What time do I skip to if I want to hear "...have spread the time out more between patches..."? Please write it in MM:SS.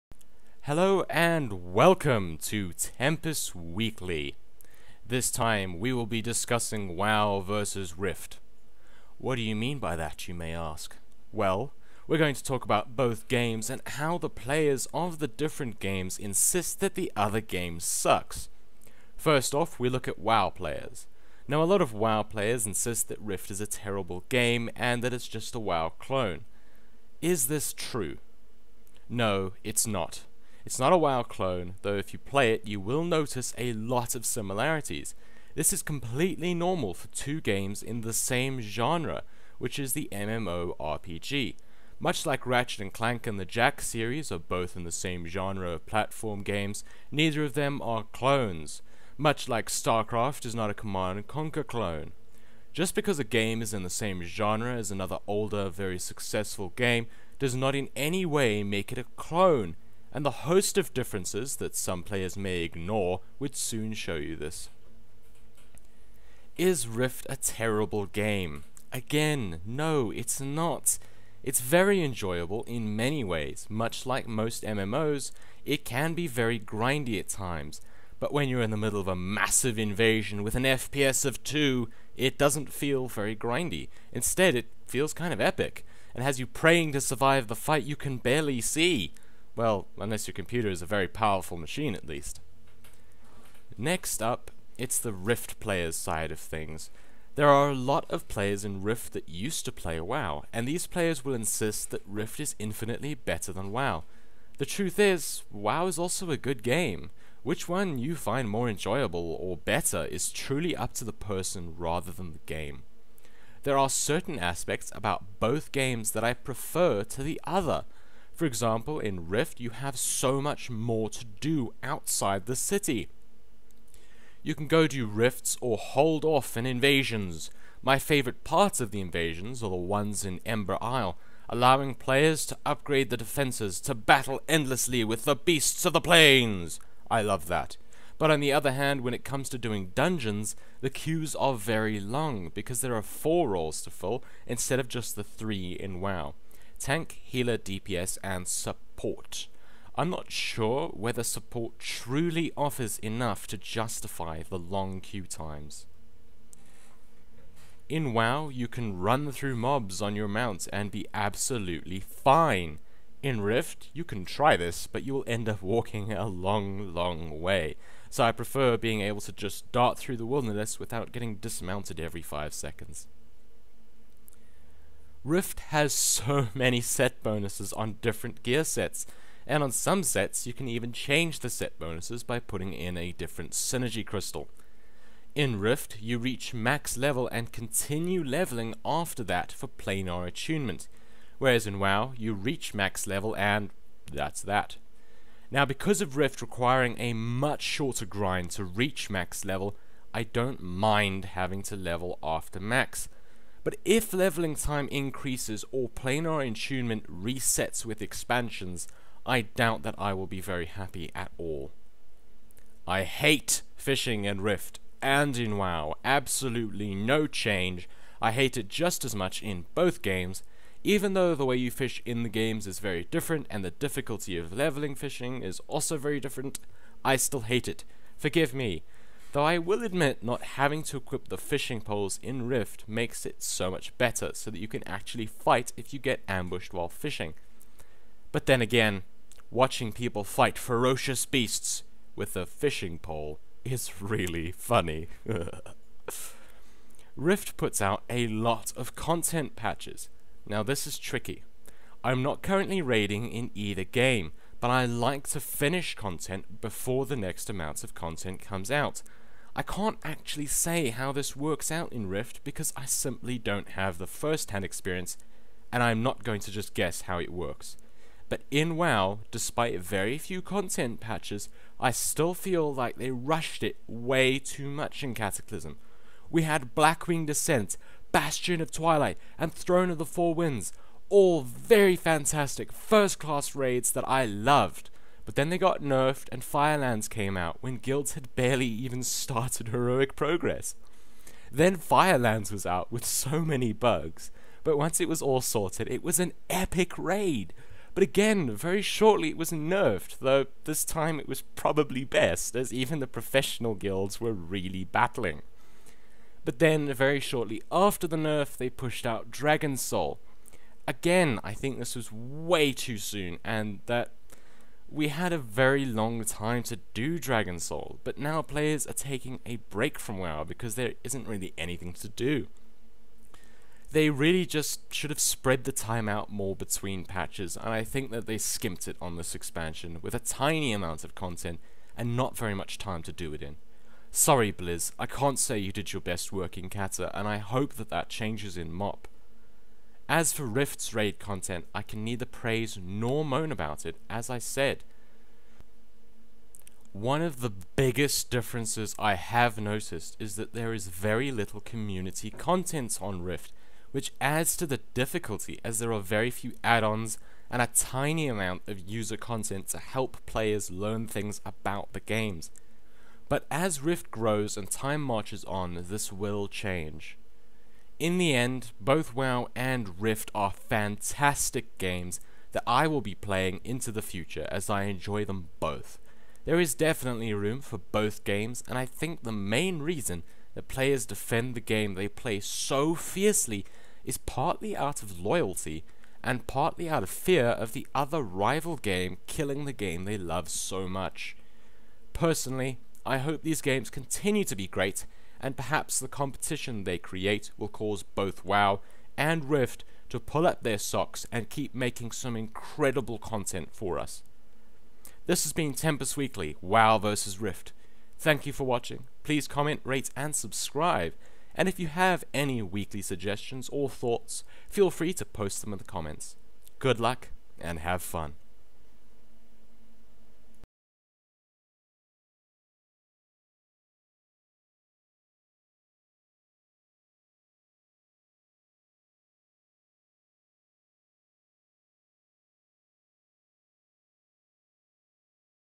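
05:25.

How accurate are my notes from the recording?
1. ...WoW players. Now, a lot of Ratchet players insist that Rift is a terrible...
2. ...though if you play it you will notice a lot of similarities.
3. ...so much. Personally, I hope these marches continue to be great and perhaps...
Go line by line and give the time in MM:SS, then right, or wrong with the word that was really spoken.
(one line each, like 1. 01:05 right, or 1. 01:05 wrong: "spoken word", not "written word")
1. 00:20 wrong: "WoW", not "Ratchet"
2. 00:31 right
3. 06:30 wrong: "games", not "marches".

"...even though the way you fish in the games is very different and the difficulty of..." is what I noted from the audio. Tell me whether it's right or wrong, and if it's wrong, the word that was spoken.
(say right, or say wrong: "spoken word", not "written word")
right.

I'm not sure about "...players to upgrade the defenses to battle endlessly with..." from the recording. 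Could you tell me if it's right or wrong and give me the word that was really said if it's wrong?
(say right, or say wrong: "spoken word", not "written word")
right.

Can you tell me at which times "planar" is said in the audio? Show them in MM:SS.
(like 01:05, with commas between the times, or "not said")
03:09, 03:25.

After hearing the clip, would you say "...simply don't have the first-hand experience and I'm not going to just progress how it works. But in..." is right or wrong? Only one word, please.
wrong.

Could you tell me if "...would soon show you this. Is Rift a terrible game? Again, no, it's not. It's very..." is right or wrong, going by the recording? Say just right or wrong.
right.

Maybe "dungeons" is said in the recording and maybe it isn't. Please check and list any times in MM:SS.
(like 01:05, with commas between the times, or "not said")
02:19.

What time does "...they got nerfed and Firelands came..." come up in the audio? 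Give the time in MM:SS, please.
04:45.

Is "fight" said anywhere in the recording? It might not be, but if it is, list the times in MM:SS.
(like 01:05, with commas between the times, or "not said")
01:27, 03:55, 04:00.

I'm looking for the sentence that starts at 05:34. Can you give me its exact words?
Sorry, Blizz, I can't say you did your best work in Cata, and I hope that that changes in MOP.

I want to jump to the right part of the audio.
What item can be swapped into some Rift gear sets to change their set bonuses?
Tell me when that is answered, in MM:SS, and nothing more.
03:03.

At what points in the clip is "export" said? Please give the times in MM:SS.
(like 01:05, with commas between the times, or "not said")
not said.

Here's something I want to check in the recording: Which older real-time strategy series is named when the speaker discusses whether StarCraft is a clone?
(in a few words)
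Command and Conquer.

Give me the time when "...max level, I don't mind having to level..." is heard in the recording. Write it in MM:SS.
03:19.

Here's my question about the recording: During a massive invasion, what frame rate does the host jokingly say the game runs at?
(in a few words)
2.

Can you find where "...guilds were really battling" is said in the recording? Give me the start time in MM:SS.
05:03.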